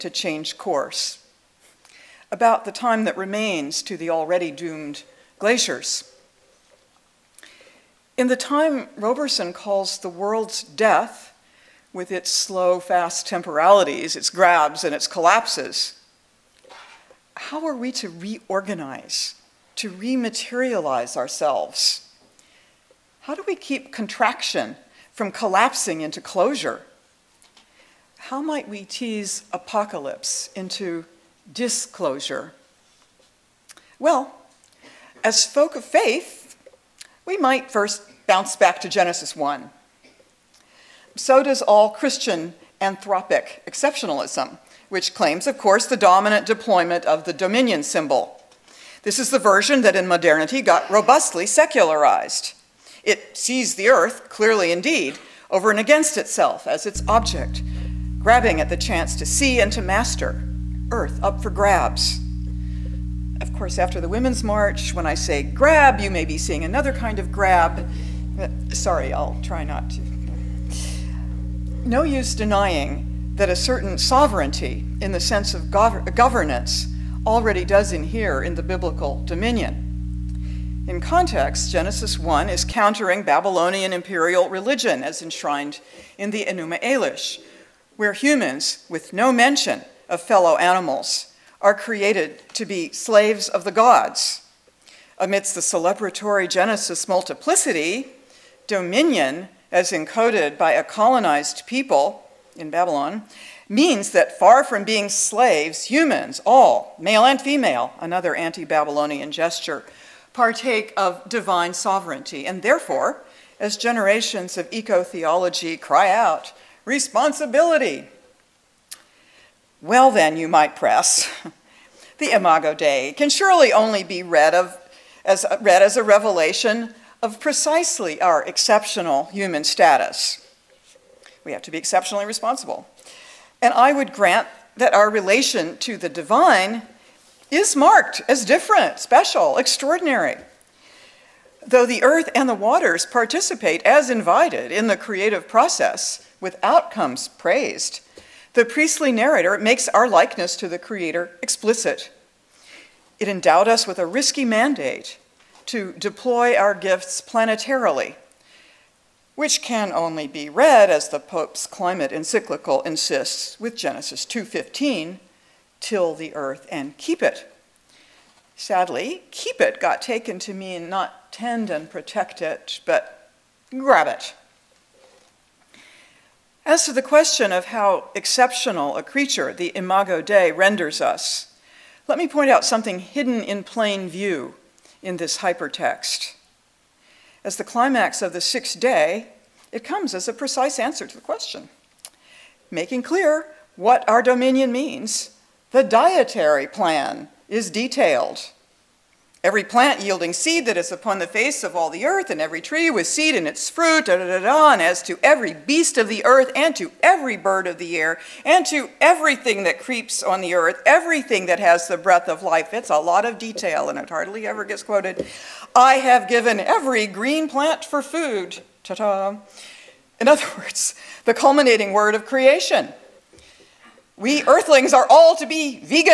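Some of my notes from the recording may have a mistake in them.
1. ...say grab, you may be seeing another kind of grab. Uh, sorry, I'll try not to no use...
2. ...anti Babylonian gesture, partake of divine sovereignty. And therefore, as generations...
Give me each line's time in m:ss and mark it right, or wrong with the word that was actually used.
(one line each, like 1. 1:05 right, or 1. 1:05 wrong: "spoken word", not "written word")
1. 1:05 right
2. 1:48 right.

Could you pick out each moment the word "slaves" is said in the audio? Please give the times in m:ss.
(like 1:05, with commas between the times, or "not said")
1:32, 1:45.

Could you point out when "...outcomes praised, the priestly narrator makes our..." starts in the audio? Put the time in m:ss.
2:26.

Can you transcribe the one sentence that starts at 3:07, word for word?
As the climax of the sixth day, it comes as a precise answer to the question, making clear what our dominion means.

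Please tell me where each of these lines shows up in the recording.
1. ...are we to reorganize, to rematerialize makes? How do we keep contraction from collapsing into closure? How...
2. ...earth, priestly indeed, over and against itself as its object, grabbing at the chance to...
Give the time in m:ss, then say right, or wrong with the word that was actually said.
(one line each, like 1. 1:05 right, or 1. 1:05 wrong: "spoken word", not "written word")
1. 0:17 wrong: "ourselves", not "makes"
2. 0:53 wrong: "clearly", not "priestly".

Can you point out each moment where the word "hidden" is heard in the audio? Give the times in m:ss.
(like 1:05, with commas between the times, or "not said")
3:02.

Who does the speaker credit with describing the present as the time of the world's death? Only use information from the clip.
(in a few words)
Roberson.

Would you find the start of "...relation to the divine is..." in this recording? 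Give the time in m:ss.
2:15.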